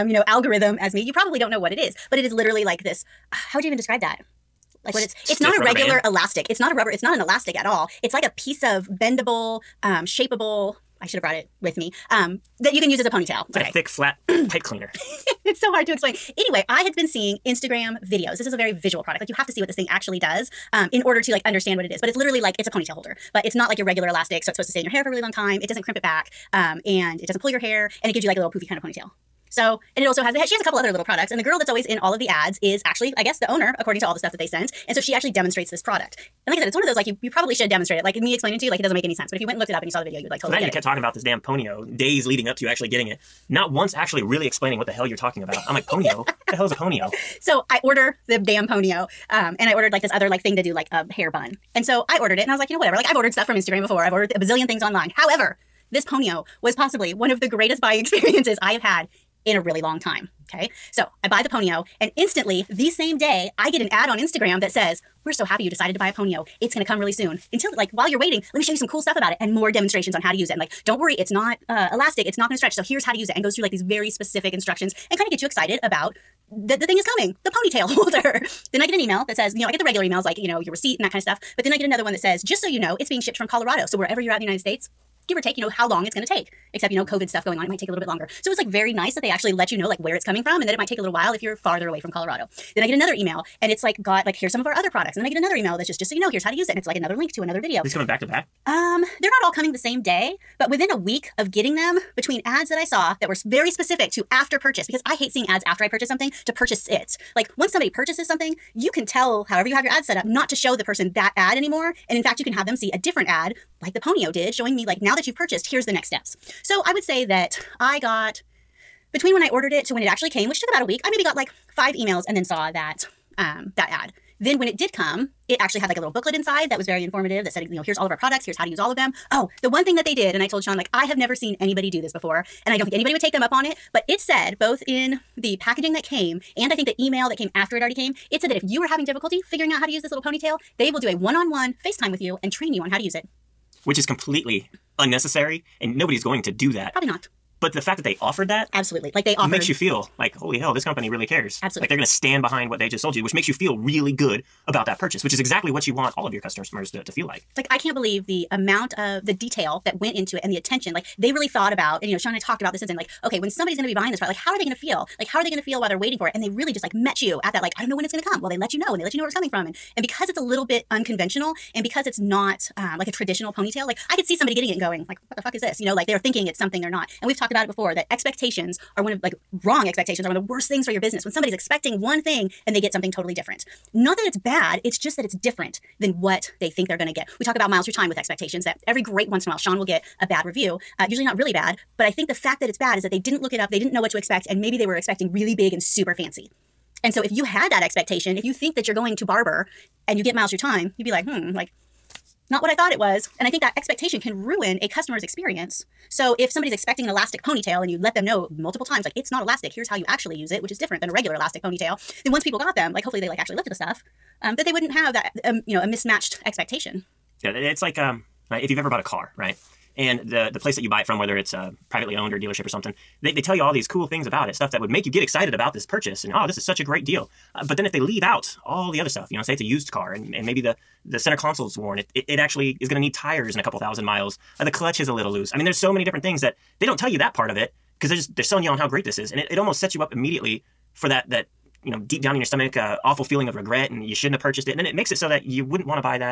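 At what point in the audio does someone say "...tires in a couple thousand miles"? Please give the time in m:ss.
3:53.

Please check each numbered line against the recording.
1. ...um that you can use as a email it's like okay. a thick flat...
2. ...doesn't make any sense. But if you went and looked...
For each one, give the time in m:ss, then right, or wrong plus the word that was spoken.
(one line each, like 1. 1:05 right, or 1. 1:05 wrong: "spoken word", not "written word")
1. 0:12 wrong: "ponytail", not "email"
2. 0:38 right.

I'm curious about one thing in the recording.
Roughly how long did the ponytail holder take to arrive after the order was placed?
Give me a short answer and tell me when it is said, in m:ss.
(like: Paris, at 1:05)
about a week, at 2:00.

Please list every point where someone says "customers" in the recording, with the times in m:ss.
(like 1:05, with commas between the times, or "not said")
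2:36, 3:24.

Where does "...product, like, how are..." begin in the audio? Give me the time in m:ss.
2:44.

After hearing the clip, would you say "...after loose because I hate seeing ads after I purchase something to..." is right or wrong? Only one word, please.
wrong.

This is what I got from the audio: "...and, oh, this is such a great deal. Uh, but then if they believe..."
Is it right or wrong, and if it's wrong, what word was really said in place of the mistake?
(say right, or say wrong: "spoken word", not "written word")
wrong: "leave", not "believe".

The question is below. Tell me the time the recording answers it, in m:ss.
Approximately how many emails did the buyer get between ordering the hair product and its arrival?
2:01.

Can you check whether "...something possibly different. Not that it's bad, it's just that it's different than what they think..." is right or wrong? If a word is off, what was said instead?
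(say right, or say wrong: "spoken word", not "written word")
wrong: "totally", not "possibly".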